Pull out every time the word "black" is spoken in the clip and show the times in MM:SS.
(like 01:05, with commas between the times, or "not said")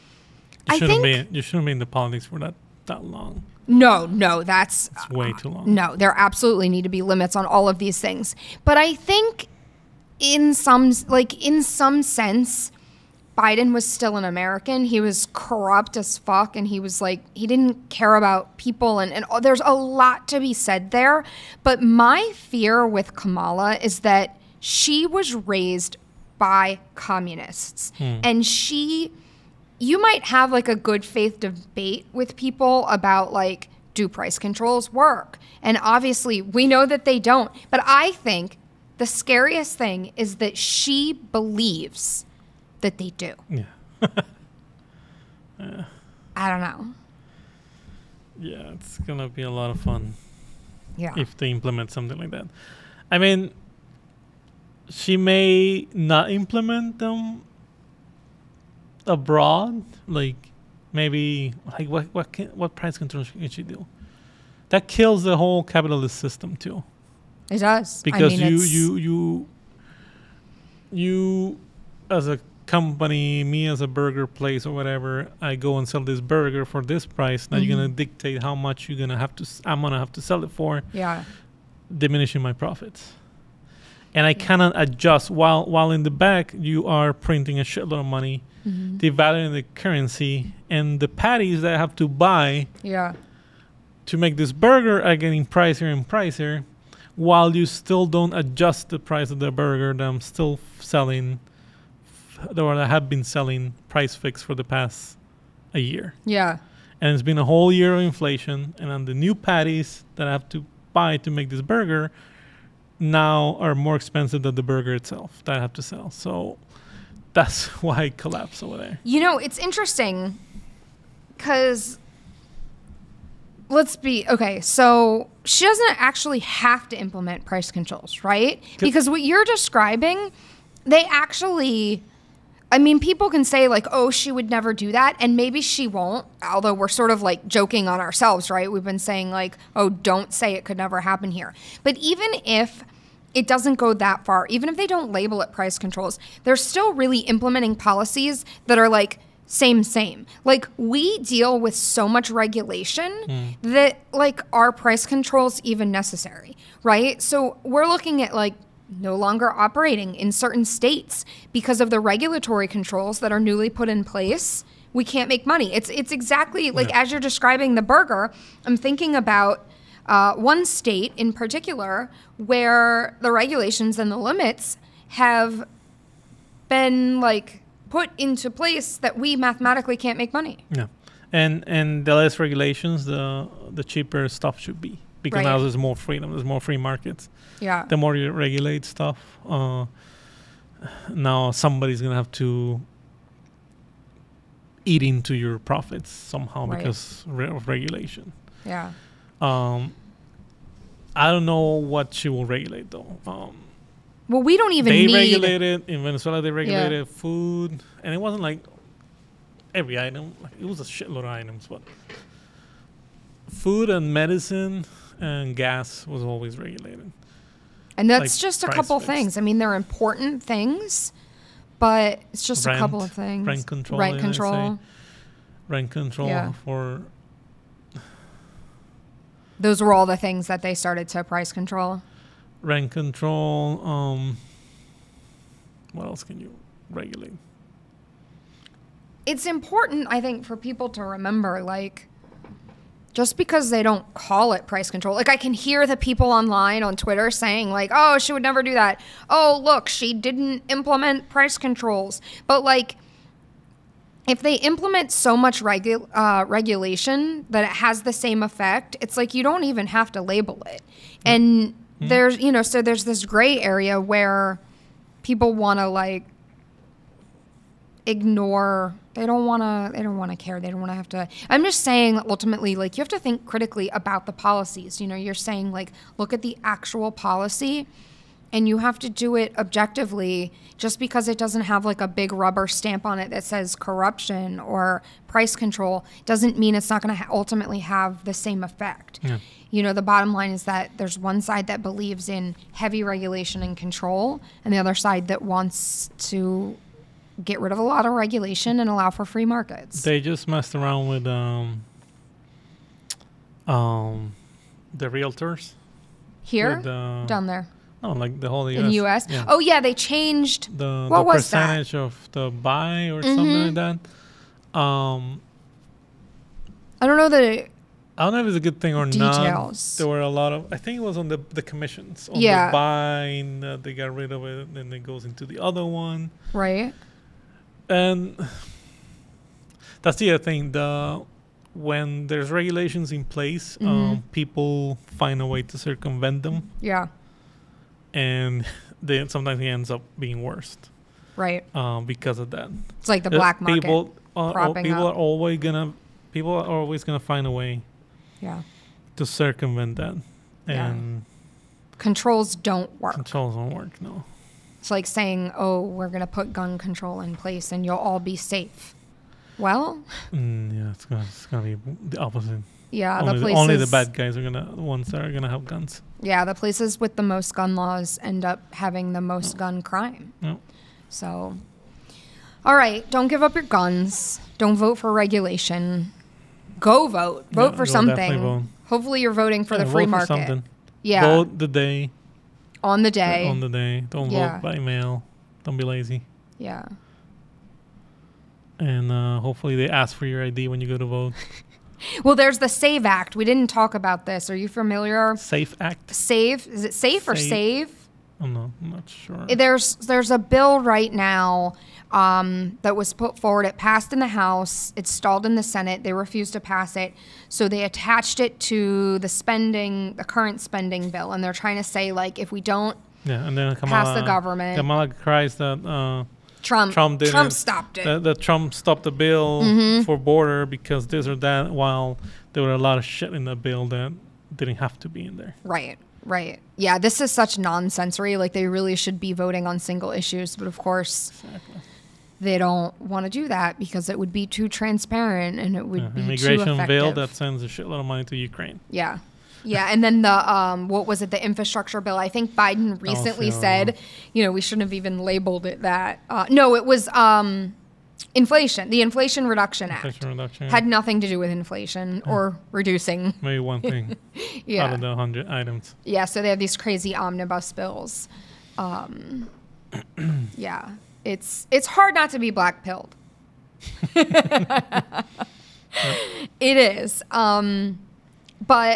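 05:43, 07:42.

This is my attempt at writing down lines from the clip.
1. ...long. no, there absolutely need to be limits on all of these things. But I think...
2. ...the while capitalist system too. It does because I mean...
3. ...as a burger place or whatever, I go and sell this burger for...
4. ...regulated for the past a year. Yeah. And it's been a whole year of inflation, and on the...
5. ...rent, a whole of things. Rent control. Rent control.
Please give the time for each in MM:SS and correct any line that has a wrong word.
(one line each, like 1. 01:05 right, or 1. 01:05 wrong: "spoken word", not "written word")
1. 00:05 right
2. 01:05 wrong: "whole", not "while"
3. 01:13 right
4. 01:44 wrong: "fixed", not "regulated"
5. 03:42 wrong: "couple", not "whole".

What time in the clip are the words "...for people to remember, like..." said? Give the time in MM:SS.
04:00.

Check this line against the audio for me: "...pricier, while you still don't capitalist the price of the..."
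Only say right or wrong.
wrong.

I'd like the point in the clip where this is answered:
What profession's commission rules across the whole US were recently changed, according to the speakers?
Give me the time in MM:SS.
05:04.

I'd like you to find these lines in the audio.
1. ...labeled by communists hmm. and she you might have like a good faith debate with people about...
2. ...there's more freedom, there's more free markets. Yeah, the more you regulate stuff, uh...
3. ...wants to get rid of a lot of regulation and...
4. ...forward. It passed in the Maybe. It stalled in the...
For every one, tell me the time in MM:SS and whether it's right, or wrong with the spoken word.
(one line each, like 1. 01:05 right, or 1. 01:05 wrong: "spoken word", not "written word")
1. 00:25 wrong: "raised", not "labeled"
2. 03:05 right
3. 04:55 right
4. 06:43 wrong: "House", not "Maybe".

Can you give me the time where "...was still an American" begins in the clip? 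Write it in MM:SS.
00:13.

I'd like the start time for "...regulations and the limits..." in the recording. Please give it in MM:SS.
02:53.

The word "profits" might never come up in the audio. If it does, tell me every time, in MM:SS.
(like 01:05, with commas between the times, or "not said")
01:22, 03:15.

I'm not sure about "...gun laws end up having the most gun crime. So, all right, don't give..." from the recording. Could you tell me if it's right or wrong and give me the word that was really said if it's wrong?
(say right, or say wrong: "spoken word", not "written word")
right.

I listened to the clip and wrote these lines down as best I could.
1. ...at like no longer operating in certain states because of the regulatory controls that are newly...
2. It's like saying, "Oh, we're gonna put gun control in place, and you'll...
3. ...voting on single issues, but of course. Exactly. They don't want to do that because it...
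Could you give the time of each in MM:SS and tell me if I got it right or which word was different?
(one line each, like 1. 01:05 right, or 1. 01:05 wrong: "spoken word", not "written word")
1. 02:38 right
2. 05:54 right
3. 07:09 right.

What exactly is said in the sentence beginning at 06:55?
Uh, Trump Trump, Trump stopped it.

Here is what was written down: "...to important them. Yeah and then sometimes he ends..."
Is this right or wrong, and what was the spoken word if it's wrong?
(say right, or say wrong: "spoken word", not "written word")
wrong: "circumvent", not "important".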